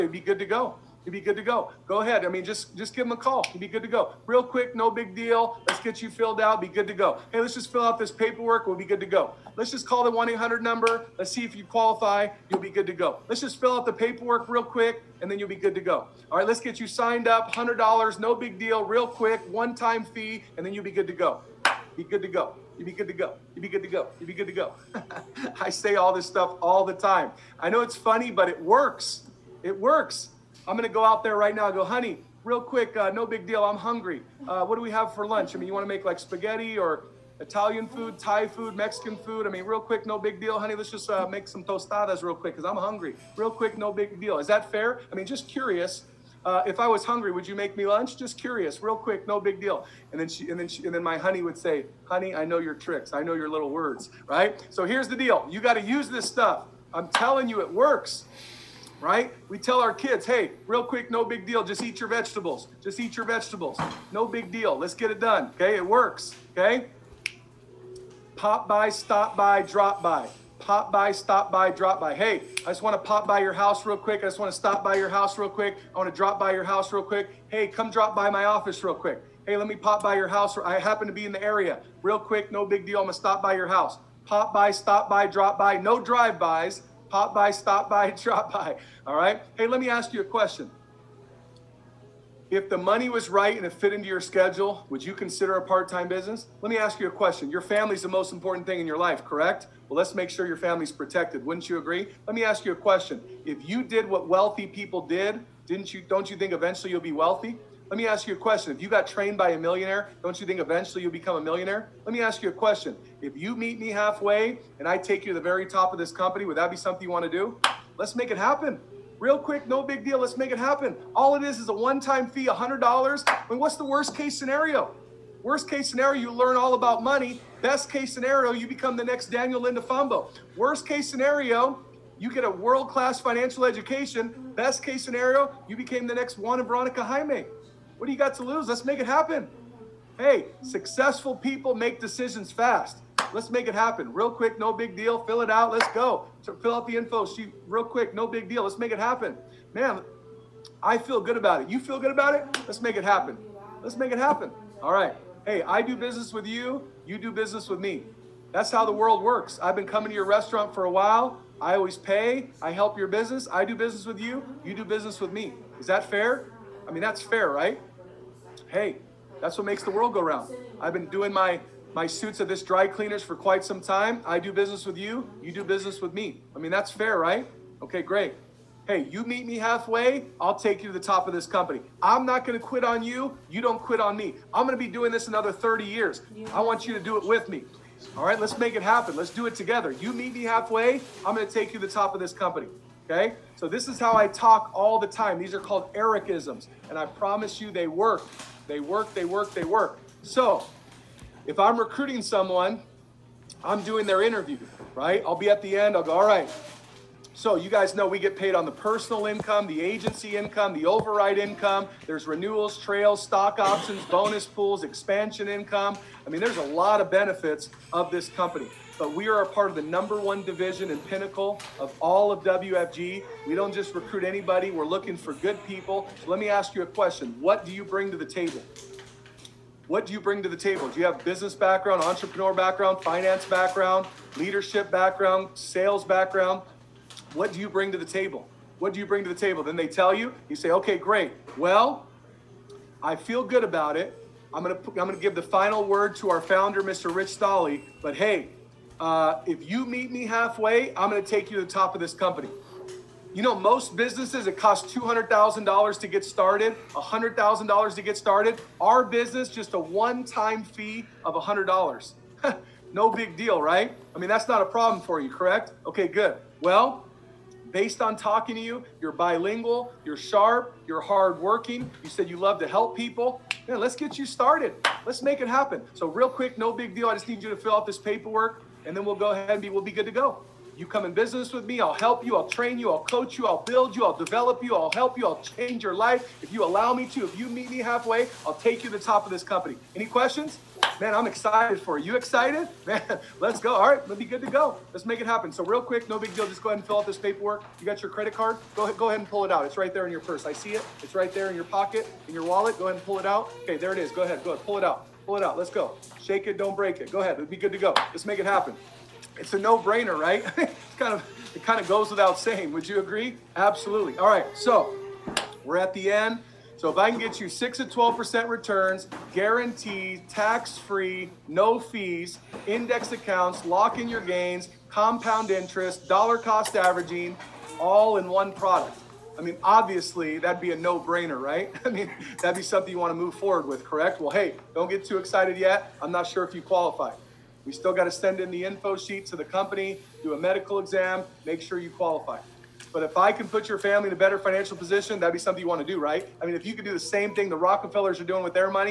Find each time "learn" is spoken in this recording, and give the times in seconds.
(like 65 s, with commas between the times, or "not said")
126 s.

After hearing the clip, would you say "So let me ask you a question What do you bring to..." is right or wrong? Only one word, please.
right.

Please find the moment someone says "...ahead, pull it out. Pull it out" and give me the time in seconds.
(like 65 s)
304 s.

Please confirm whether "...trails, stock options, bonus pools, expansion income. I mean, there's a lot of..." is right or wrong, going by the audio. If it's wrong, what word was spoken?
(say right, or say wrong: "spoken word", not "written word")
right.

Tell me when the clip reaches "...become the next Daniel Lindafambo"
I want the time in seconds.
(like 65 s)
128 s.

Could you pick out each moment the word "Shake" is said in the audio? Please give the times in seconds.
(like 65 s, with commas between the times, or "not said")
306 s.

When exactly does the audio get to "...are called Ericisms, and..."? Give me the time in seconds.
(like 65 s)
195 s.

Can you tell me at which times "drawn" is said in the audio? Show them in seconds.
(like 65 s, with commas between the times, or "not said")
not said.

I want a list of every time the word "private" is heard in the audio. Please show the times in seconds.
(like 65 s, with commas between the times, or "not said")
not said.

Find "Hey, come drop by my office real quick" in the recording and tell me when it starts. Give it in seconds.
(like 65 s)
77 s.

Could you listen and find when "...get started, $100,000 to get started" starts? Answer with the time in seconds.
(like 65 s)
256 s.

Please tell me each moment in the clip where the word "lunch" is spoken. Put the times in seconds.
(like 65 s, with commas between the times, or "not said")
35 s, 47 s.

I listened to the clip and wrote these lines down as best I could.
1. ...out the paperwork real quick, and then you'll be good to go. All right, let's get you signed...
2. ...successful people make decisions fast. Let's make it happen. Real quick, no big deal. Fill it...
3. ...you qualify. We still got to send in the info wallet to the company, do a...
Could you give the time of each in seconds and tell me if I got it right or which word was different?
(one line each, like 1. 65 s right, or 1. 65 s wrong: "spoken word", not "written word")
1. 13 s right
2. 140 s right
3. 336 s wrong: "sheet", not "wallet".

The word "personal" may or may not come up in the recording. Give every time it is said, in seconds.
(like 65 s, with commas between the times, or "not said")
208 s.